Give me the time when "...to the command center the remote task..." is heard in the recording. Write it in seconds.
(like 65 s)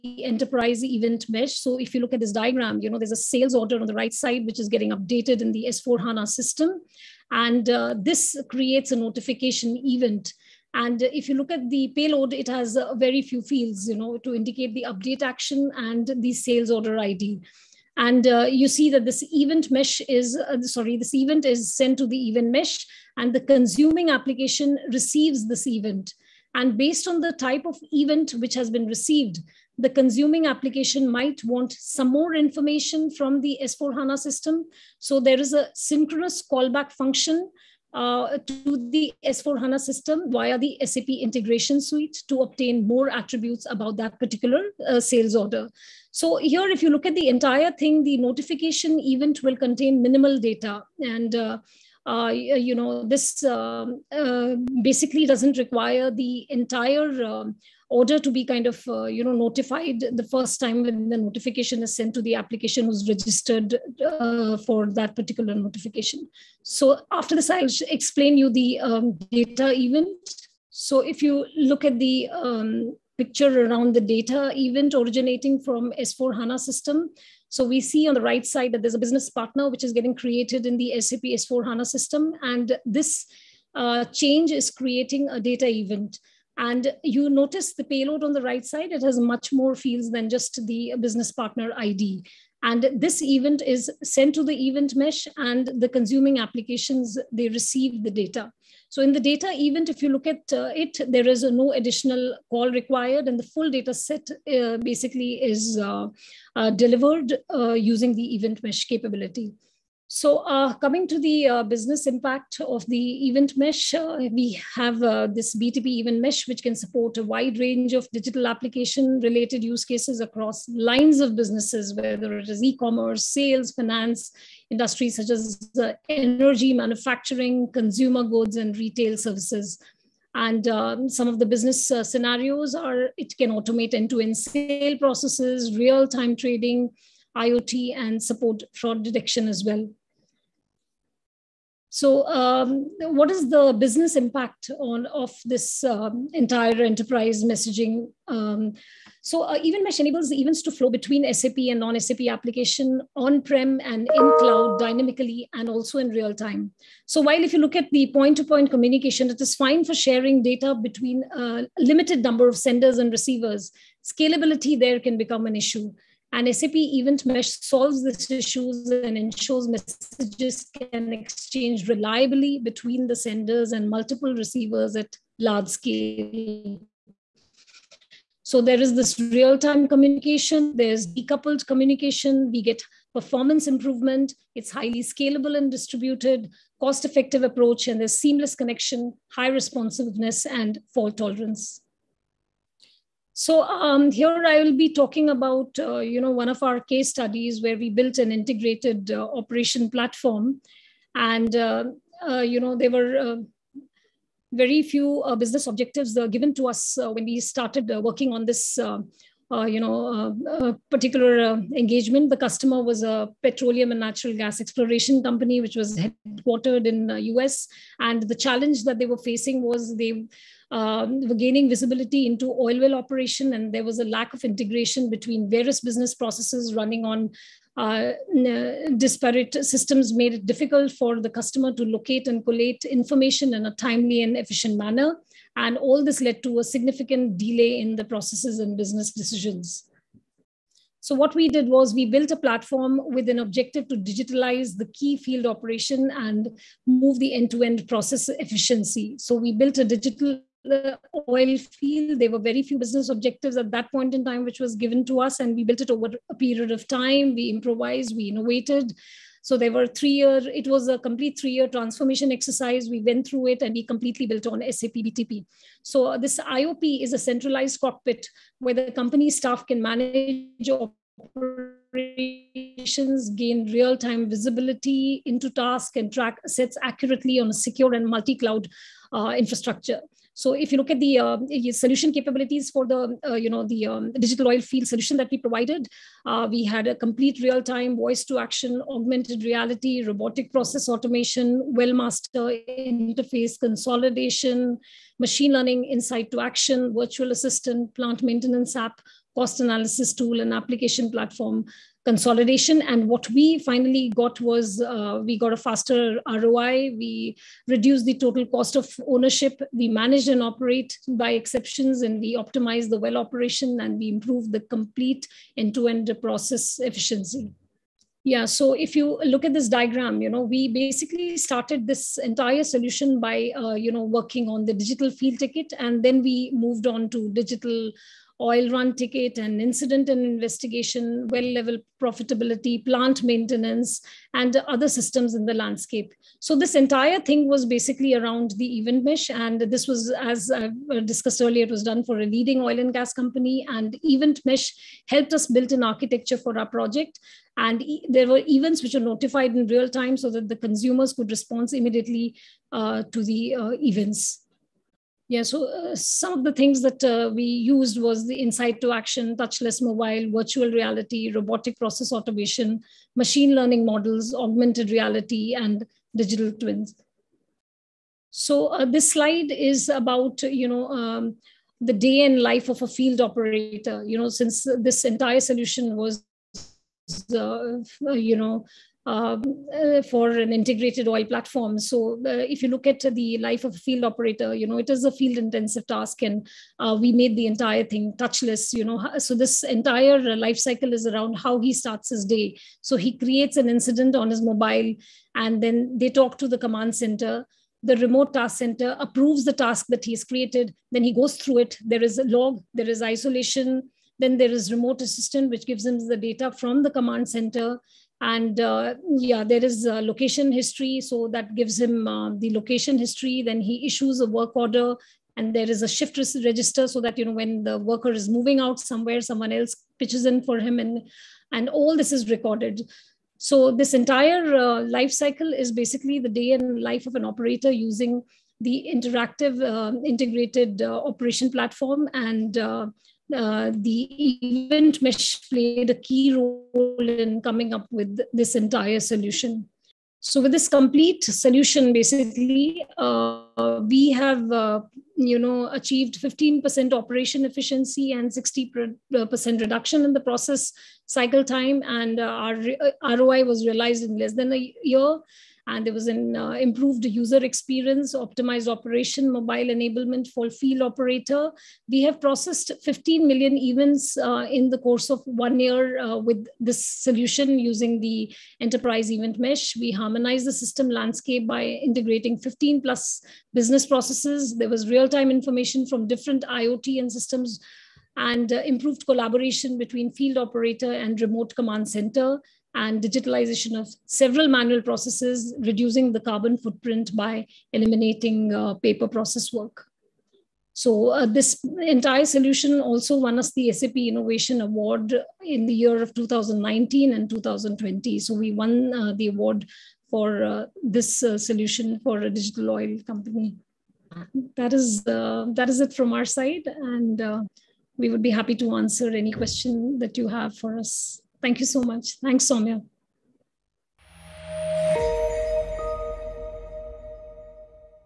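396 s.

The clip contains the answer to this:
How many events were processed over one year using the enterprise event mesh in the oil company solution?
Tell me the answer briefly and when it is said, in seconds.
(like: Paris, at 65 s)
15 million, at 462 s.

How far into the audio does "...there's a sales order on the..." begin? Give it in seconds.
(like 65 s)
2 s.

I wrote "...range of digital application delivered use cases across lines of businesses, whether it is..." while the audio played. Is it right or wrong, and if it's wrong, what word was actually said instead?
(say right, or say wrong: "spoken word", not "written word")
wrong: "related", not "delivered".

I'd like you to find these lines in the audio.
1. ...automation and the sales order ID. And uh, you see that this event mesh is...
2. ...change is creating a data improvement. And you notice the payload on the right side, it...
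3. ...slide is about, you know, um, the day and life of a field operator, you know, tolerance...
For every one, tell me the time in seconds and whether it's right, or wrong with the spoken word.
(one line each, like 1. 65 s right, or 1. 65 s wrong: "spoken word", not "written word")
1. 15 s wrong: "action", not "automation"
2. 84 s wrong: "event", not "improvement"
3. 369 s wrong: "since", not "tolerance".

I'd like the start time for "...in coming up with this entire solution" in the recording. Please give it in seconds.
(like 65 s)
437 s.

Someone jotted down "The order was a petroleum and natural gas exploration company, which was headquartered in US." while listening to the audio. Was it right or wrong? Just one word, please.
wrong.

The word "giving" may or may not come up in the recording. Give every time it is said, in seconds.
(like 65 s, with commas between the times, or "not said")
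not said.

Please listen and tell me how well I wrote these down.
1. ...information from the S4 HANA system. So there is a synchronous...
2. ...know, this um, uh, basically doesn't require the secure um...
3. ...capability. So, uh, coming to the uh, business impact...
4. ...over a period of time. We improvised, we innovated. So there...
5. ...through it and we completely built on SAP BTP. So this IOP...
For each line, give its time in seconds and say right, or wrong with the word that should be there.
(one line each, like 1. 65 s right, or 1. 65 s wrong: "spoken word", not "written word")
1. 32 s right
2. 52 s wrong: "entire", not "secure"
3. 108 s right
4. 255 s right
5. 263 s right.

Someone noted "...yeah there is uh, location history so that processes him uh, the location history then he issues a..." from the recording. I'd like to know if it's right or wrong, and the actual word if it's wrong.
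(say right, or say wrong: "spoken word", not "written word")
wrong: "gives", not "processes".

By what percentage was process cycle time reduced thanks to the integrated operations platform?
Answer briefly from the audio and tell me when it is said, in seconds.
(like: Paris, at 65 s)
60%, at 448 s.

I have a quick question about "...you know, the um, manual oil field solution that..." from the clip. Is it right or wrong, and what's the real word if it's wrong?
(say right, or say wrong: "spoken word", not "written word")
wrong: "digital", not "manual".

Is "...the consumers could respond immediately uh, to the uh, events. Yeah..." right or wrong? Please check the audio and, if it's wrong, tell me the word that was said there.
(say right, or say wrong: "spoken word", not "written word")
right.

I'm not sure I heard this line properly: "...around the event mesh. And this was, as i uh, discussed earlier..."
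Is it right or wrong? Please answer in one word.
right.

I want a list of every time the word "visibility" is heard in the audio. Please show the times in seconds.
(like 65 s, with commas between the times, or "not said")
221 s, 274 s.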